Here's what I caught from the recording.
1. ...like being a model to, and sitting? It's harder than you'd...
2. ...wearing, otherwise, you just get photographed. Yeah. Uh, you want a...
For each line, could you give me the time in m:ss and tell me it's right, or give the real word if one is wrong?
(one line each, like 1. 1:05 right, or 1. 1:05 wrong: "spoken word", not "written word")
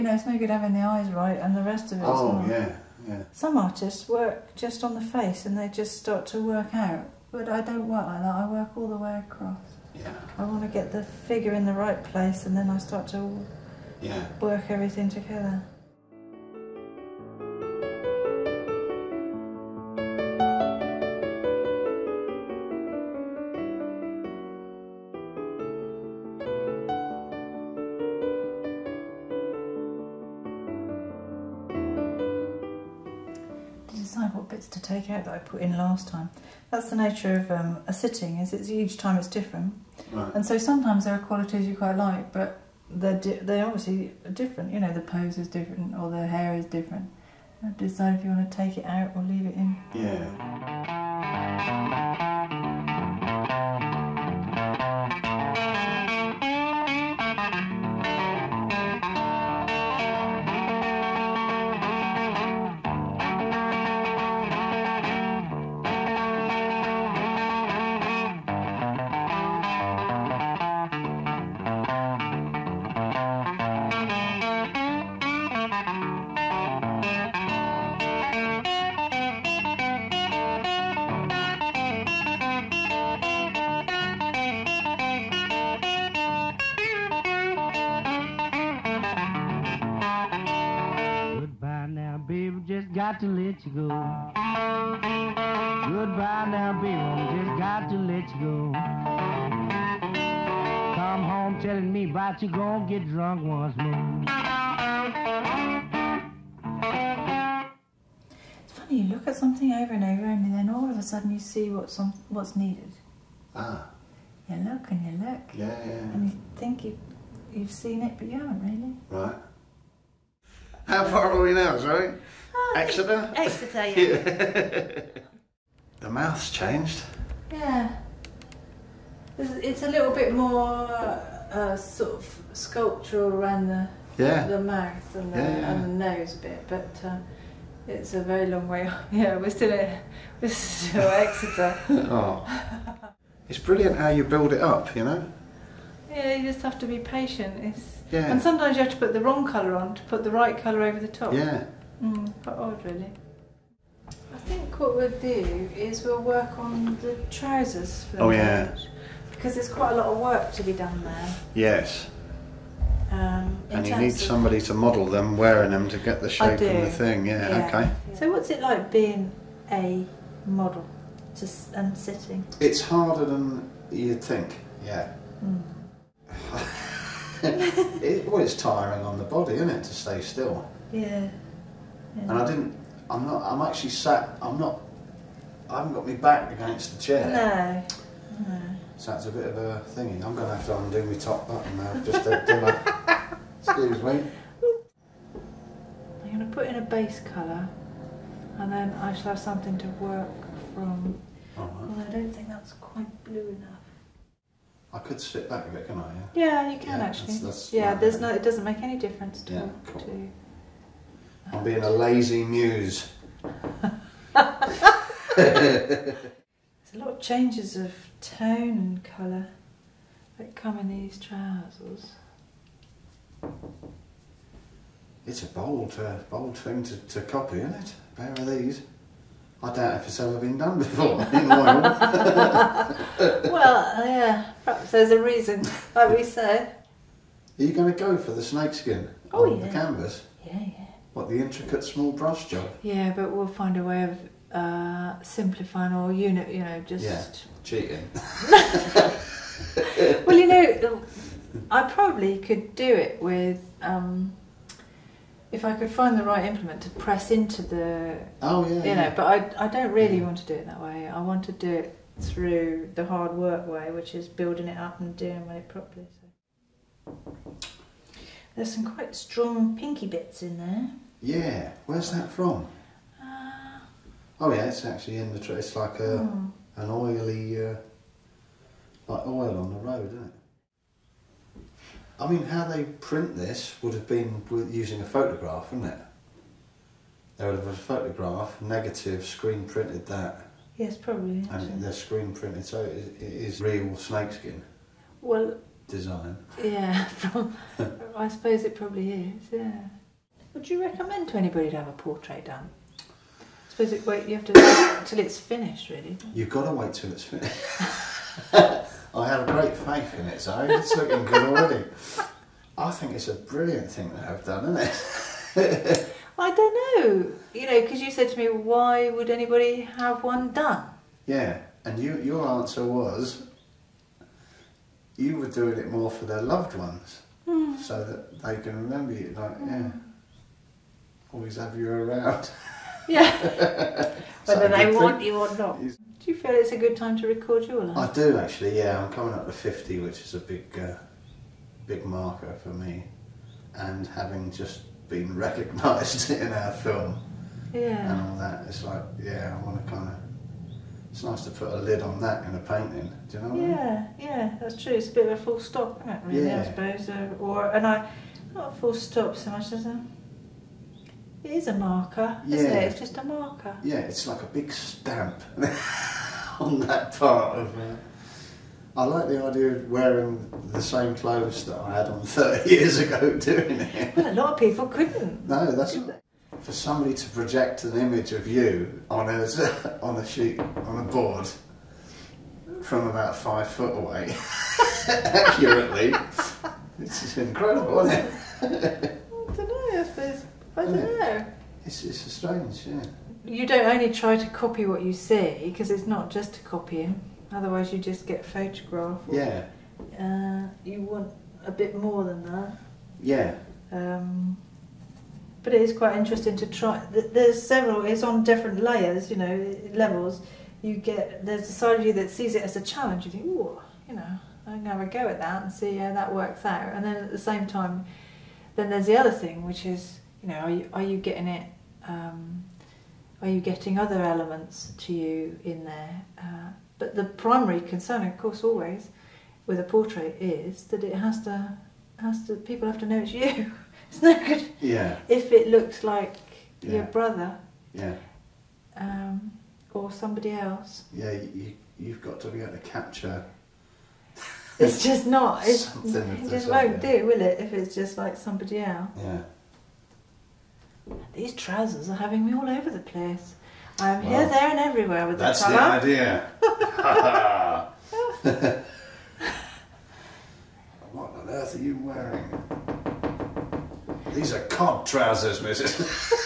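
1. 2:48 right
2. 6:36 wrong: "copying", not "wearing".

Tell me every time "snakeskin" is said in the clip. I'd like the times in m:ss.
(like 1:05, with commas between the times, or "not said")
3:58, 4:53.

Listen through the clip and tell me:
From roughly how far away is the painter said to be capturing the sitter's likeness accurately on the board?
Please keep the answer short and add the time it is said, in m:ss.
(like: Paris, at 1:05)
five foot, at 6:23.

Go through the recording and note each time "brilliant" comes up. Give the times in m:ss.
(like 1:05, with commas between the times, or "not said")
2:23, 5:13.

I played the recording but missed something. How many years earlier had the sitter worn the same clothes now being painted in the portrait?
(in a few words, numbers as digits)
30.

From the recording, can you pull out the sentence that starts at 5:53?
Do you know what yeah, I mean?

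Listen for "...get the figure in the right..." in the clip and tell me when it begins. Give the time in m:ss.
0:10.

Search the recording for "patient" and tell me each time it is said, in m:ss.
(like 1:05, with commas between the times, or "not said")
2:26.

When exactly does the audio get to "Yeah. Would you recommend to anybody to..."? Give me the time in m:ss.
4:59.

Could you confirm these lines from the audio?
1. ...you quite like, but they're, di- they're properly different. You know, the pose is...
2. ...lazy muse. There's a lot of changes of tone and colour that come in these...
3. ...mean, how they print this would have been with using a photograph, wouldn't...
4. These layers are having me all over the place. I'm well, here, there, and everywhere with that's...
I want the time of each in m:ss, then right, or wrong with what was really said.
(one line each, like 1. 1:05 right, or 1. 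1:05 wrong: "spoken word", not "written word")
1. 0:41 wrong: "obviously", not "properly"
2. 3:31 right
3. 4:42 right
4. 7:31 wrong: "trousers", not "layers".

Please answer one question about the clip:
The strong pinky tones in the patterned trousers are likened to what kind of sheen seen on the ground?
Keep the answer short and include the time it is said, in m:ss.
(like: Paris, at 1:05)
oil on the road, at 4:39.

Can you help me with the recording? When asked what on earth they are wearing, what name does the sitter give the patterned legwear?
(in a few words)
cod trousers.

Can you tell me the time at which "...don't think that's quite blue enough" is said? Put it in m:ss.
3:22.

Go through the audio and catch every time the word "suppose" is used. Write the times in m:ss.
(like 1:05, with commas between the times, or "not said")
4:58, 5:03, 5:56.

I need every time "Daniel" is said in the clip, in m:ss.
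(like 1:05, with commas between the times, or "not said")
not said.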